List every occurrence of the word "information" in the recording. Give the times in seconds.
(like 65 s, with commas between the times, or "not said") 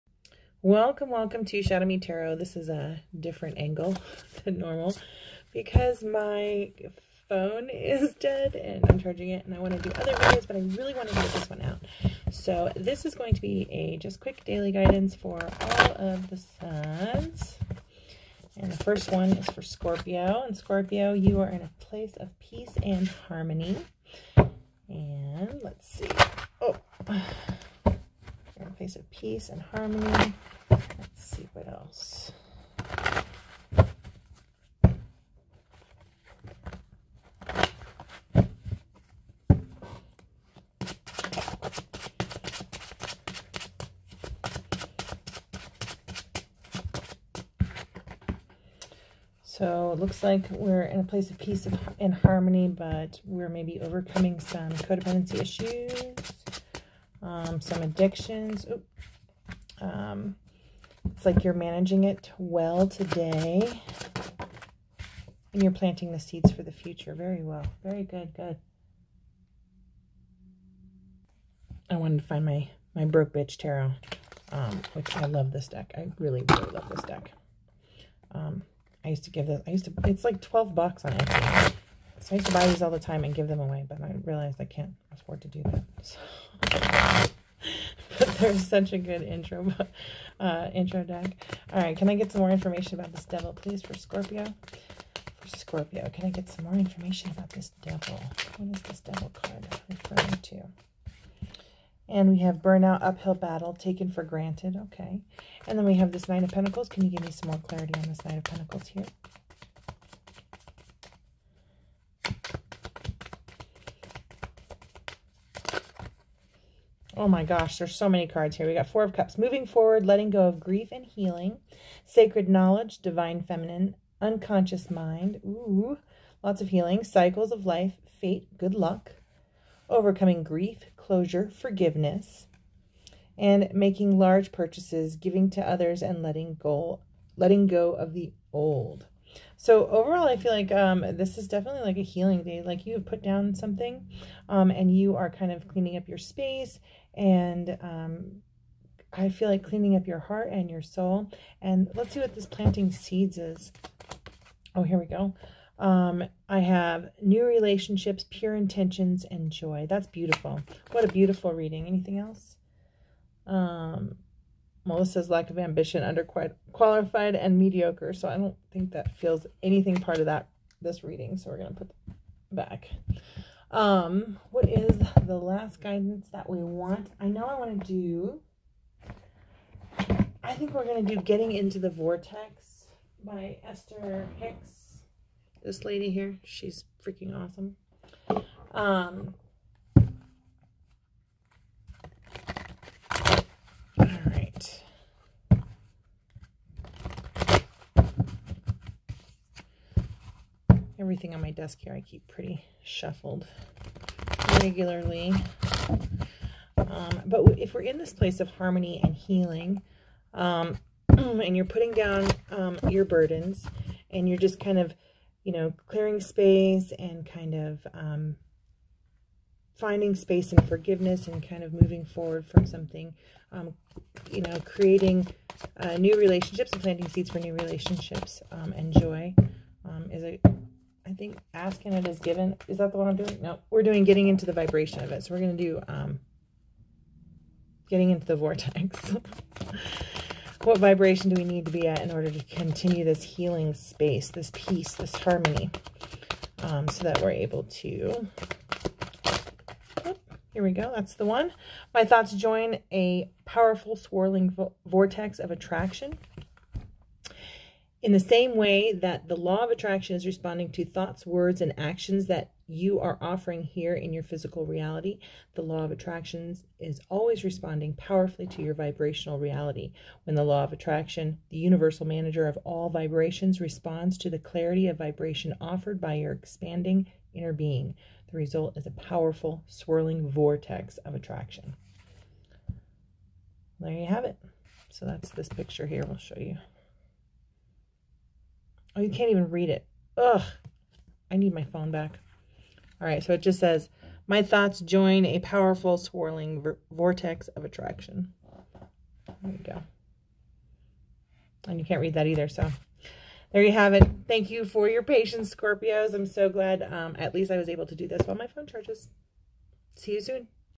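92 s, 96 s.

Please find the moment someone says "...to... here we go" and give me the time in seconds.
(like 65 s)
247 s.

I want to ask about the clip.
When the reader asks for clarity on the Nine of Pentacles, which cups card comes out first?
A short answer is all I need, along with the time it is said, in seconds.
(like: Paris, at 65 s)
Four of Cups, at 118 s.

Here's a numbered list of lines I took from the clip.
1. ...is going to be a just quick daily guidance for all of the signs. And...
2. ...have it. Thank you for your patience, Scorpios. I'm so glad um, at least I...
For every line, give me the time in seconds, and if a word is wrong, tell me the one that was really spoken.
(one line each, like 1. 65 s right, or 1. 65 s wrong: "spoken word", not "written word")
1. 13 s right
2. 303 s right.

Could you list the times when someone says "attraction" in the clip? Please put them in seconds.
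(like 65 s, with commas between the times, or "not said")
255 s, 259 s, 265 s, 270 s, 281 s, 297 s.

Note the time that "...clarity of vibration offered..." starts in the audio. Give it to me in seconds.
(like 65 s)
274 s.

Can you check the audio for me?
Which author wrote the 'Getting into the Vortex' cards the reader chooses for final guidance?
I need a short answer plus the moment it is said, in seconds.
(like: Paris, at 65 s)
Esther Hicks, at 183 s.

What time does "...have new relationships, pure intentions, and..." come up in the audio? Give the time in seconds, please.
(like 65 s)
156 s.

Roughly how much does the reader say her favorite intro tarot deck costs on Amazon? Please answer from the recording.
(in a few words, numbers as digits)
12 bucks.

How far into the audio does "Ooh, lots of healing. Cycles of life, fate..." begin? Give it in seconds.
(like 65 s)
125 s.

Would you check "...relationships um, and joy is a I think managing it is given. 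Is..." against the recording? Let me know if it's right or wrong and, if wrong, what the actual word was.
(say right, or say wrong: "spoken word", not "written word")
wrong: "asking", not "managing".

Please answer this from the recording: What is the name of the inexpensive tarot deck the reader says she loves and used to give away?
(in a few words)
Broke Bitch Tarot.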